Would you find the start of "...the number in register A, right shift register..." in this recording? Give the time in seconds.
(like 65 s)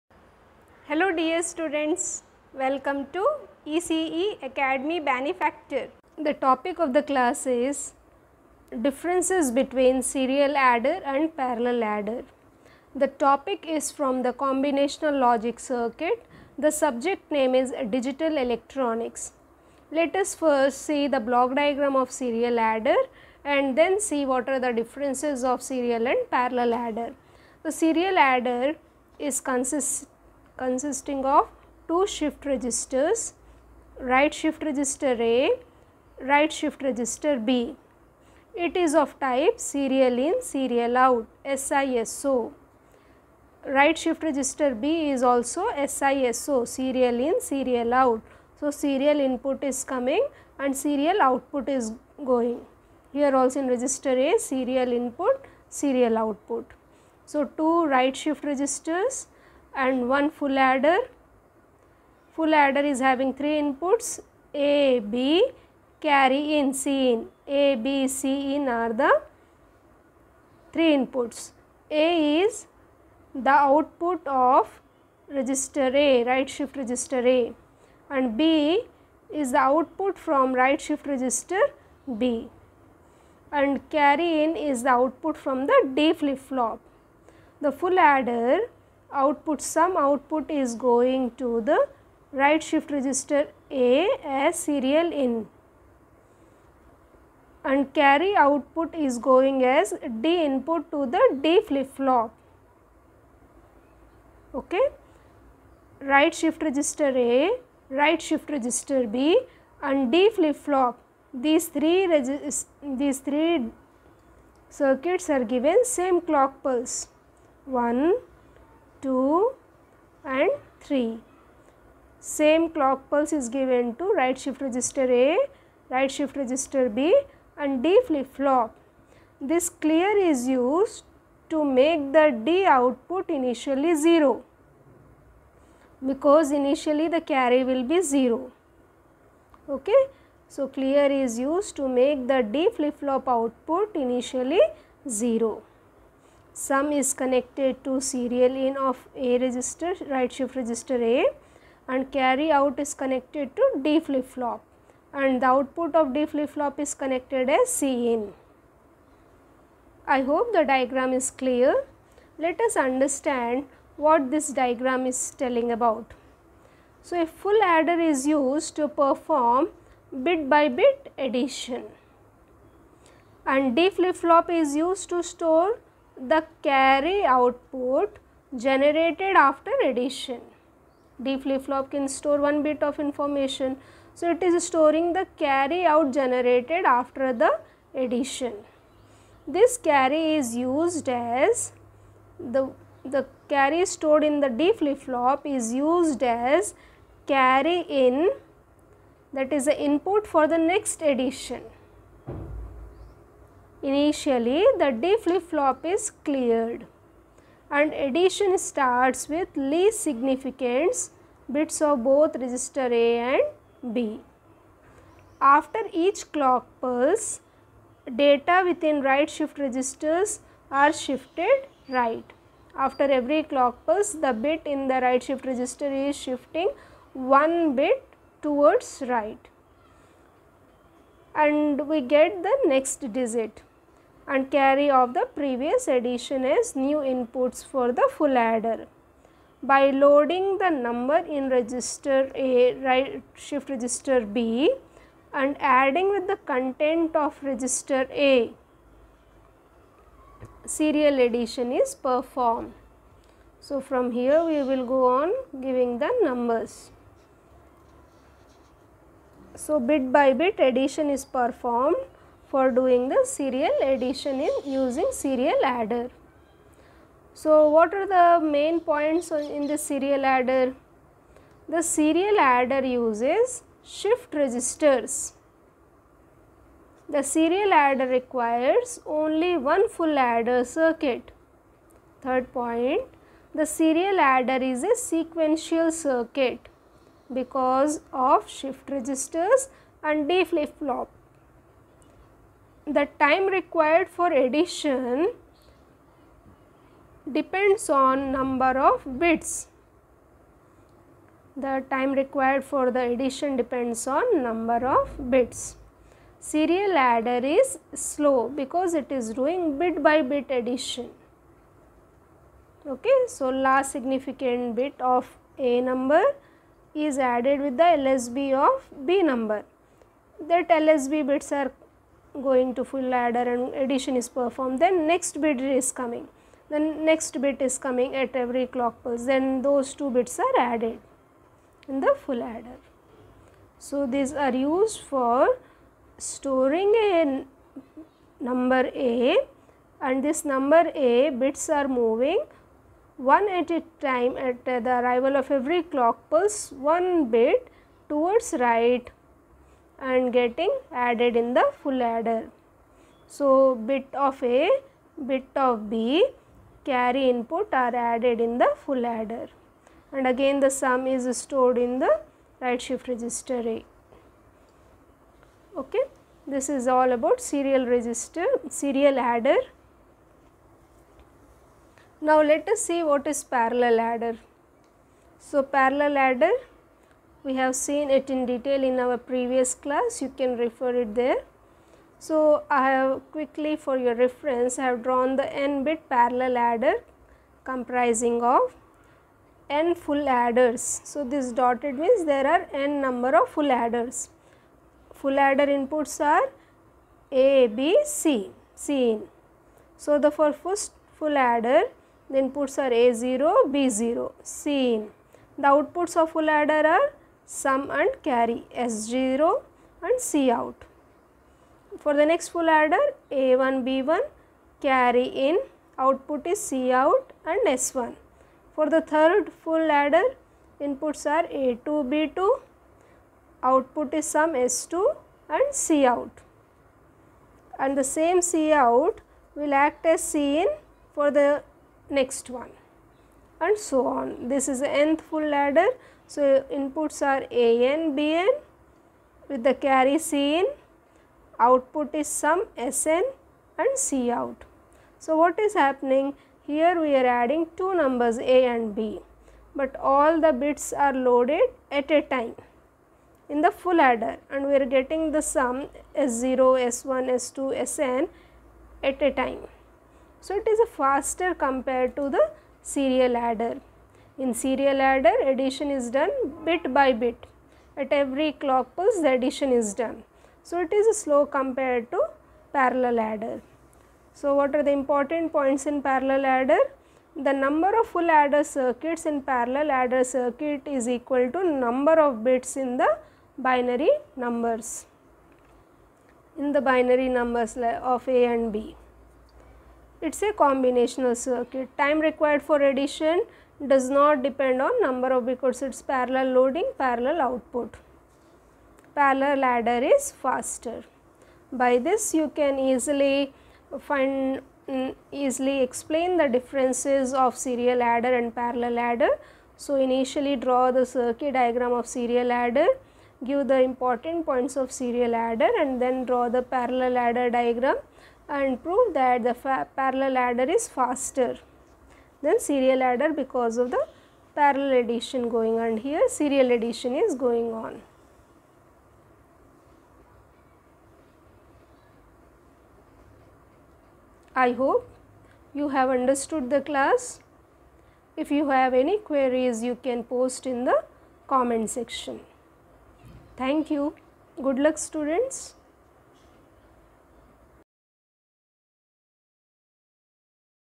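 240 s.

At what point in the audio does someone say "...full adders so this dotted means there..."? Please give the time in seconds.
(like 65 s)
389 s.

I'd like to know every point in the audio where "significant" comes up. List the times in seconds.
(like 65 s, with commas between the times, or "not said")
210 s, 313 s.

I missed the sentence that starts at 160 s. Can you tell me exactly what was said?
I hope the diagram is clear.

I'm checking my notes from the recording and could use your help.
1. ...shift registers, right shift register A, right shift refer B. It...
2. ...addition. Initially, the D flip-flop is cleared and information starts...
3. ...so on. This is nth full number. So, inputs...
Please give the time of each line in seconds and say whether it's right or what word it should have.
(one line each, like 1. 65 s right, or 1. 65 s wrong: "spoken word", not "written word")
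1. 32 s wrong: "register", not "refer"
2. 201 s wrong: "addition", not "information"
3. 433 s wrong: "adder", not "number".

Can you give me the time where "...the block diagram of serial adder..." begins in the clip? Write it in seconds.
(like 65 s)
21 s.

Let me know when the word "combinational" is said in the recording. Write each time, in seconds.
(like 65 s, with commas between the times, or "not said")
14 s, 490 s.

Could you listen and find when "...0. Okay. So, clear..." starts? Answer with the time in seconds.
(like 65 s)
138 s.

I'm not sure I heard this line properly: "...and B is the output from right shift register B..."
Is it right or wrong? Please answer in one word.
right.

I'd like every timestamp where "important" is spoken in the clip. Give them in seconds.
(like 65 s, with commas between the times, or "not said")
474 s, 513 s.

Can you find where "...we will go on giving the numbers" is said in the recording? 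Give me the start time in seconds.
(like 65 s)
254 s.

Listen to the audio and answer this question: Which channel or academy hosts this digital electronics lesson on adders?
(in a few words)
ECE Academy Benefactor.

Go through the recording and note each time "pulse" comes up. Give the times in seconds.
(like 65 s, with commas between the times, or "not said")
116 s, 123 s, 216 s, 223 s, 329 s, 346 s, 468 s.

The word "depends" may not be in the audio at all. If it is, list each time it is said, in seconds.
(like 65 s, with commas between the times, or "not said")
297 s, 303 s, 494 s.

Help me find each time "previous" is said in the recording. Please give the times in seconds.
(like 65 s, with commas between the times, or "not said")
235 s, 379 s.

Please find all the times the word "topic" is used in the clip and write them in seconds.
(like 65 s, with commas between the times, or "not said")
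6 s, 13 s.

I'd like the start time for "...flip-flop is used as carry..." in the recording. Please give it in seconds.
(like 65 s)
194 s.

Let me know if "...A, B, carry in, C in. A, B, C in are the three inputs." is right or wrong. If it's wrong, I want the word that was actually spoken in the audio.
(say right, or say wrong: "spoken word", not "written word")
right.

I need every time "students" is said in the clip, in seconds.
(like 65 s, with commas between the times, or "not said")
1 s, 544 s.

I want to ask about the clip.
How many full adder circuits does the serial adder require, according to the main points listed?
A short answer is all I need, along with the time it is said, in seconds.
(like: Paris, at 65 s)
1, at 279 s.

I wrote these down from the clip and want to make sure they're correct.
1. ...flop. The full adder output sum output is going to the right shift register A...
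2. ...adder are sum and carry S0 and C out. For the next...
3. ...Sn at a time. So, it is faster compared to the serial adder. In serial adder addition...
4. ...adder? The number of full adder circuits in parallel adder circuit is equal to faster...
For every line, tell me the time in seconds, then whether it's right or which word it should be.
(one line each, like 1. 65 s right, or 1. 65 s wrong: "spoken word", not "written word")
1. 86 s right
2. 406 s right
3. 457 s right
4. 476 s wrong: "number", not "faster".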